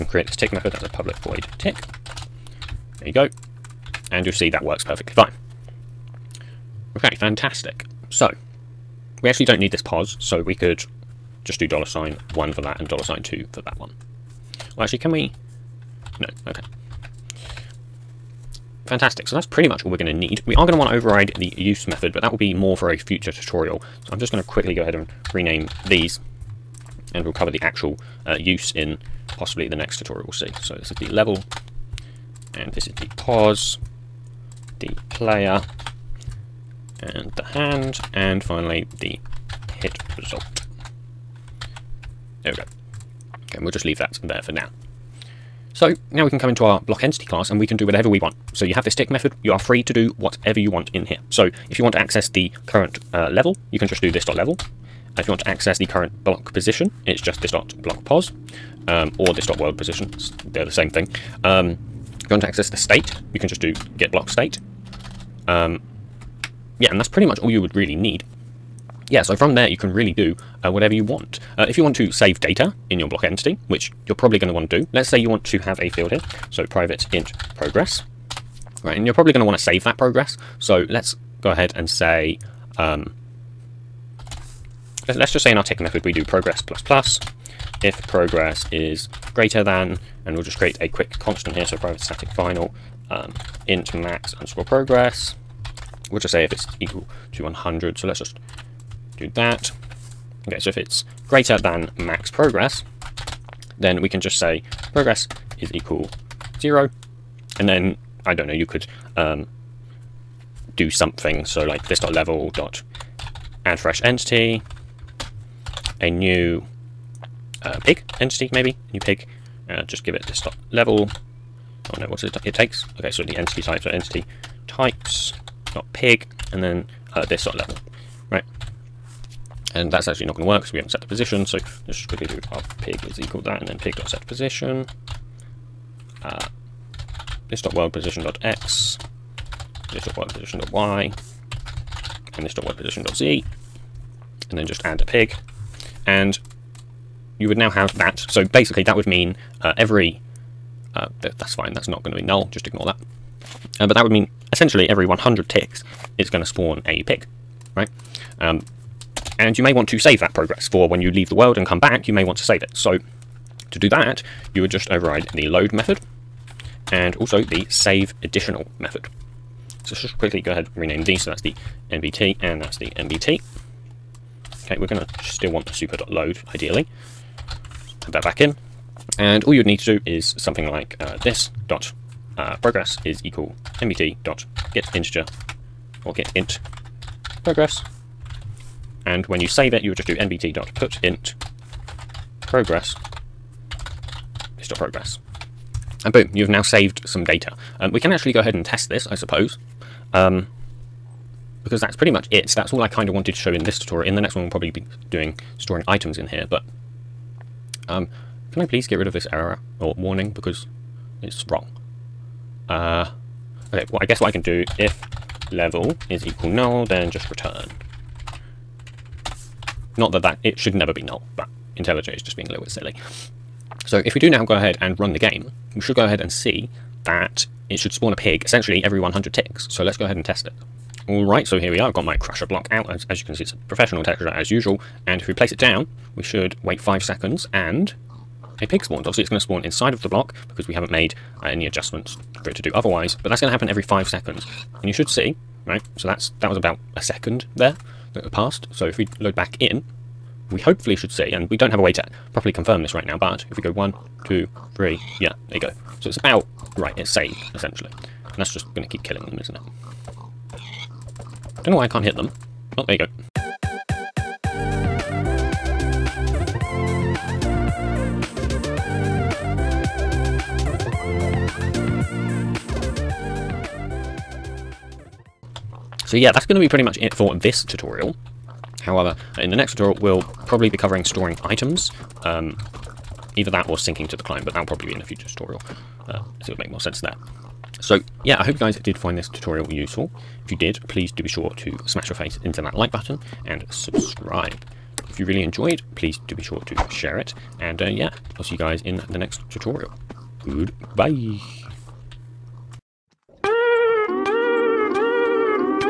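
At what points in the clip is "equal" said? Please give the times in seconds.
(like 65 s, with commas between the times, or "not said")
96 s, 105 s, 133 s, 183 s, 216 s.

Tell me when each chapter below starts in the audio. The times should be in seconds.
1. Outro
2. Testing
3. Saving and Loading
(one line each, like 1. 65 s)
1. 276 s
2. 230 s
3. 164 s.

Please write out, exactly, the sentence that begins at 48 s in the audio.
So you have this tick method, you are free to do whatever you want in here.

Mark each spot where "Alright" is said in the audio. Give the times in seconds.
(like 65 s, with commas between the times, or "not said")
231 s.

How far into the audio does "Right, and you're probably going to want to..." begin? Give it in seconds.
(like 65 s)
78 s.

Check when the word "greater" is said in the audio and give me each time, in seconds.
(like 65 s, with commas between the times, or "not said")
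89 s, 101 s.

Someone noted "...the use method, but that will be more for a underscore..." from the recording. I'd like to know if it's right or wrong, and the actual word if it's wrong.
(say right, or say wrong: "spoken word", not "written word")
wrong: "future", not "underscore".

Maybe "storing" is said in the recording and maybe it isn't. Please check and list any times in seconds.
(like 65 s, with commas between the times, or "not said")
205 s, 281 s.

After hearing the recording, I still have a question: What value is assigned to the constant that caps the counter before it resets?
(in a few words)
100.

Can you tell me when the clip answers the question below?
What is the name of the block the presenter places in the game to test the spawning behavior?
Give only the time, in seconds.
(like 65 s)
232 s.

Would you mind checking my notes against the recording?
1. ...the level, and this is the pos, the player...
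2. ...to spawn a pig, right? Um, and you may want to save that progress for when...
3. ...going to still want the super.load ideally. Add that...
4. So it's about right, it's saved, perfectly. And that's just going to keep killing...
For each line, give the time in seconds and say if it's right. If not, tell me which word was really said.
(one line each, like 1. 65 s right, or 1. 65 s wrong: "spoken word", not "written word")
1. 31 s right
2. 156 s right
3. 174 s right
4. 256 s wrong: "essentially", not "perfectly".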